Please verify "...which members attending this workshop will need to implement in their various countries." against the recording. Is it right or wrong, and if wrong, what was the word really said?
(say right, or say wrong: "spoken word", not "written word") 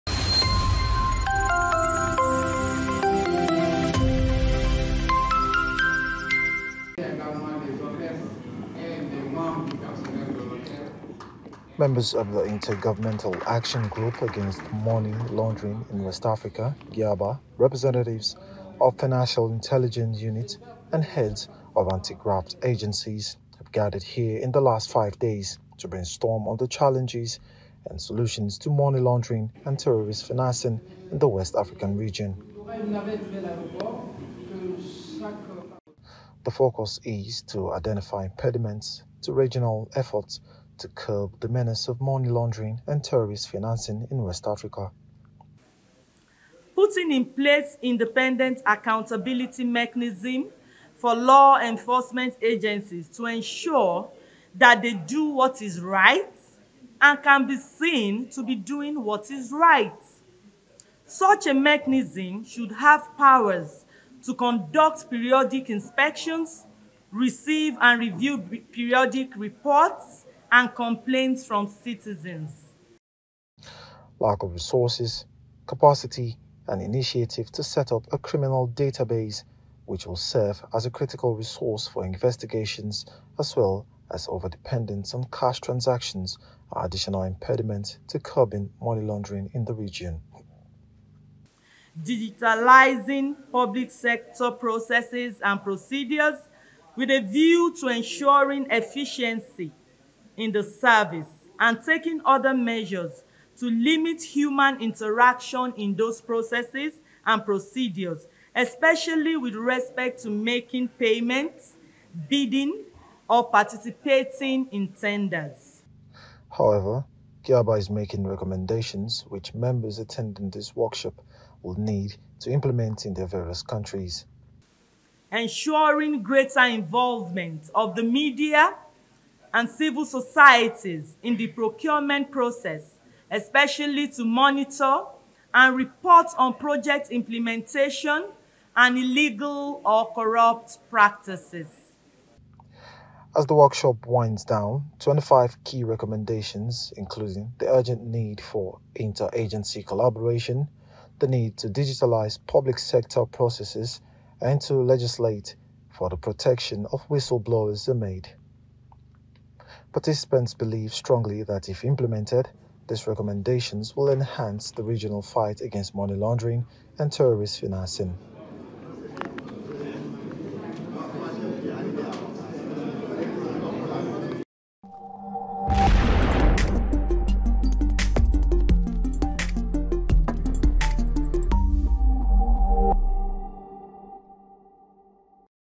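right.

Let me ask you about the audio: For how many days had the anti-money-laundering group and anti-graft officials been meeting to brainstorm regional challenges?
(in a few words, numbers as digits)
5.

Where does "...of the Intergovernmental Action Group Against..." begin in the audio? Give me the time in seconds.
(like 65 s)
12 s.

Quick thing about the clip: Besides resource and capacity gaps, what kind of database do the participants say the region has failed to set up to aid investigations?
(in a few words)
criminal database.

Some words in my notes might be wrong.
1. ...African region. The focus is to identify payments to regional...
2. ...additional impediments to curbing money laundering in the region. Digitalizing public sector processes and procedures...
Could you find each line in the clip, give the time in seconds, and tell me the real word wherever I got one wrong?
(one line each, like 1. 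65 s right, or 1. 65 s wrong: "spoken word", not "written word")
1. 31 s wrong: "impediments", not "payments"
2. 86 s right.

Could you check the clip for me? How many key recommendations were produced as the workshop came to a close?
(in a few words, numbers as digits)
25.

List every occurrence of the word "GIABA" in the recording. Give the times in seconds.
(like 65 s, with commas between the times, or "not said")
16 s, 117 s.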